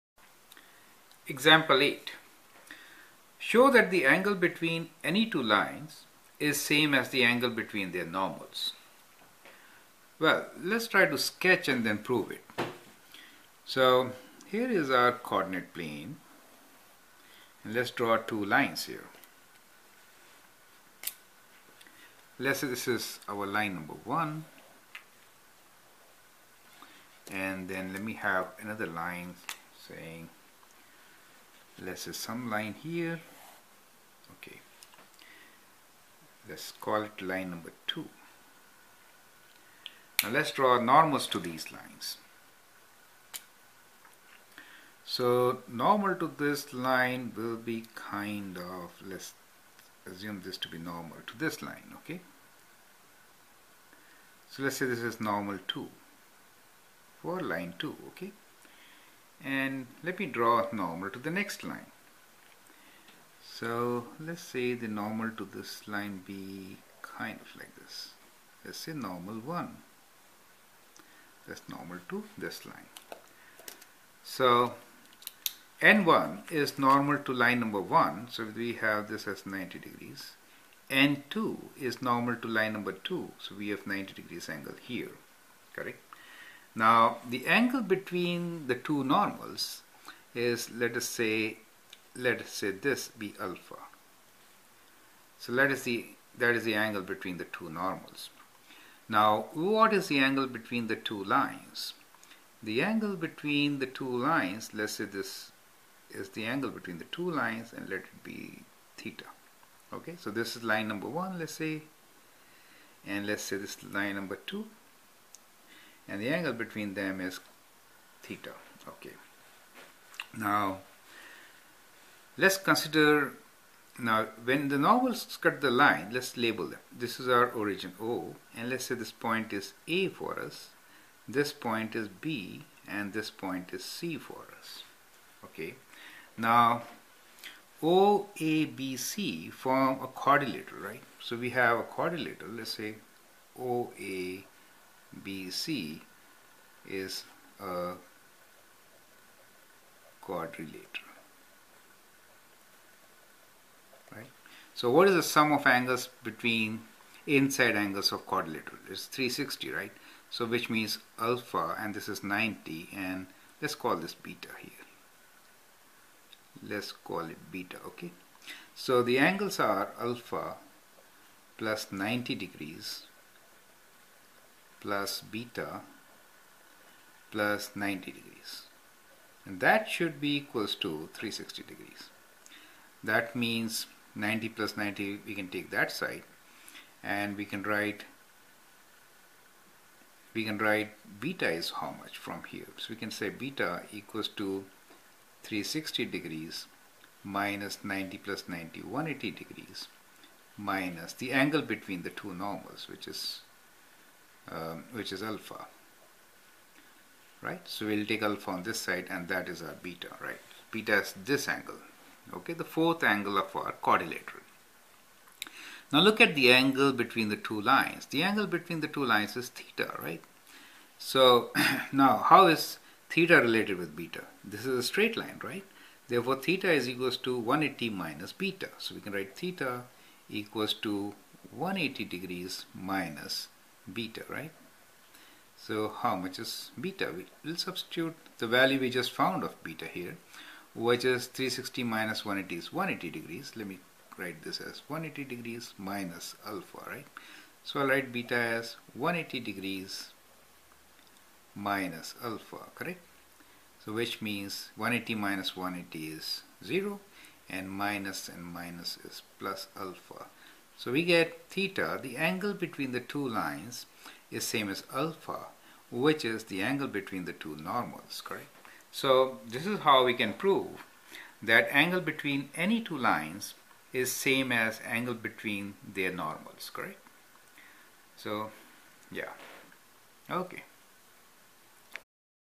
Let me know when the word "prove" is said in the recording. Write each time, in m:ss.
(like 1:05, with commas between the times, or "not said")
0:11, 4:30.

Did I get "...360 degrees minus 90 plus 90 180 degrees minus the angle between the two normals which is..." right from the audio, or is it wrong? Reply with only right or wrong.
right.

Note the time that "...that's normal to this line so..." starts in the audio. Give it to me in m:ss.
1:11.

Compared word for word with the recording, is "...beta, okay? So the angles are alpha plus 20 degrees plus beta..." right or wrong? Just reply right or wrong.
wrong.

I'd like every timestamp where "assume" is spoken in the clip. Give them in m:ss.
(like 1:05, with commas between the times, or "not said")
0:50.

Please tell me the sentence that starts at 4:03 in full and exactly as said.
Let me write this as 180 degrees minus alpha, right?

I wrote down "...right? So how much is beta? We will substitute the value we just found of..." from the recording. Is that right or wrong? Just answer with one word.
right.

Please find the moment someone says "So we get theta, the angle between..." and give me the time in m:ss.
4:20.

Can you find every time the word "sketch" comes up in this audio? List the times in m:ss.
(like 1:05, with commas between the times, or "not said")
0:11.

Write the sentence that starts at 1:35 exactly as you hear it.
So let us see, that is the angle between the two normals.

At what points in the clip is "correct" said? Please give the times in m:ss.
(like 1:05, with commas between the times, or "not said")
1:25, 4:12, 4:28, 4:36.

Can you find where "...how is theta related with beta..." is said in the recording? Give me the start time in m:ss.
3:42.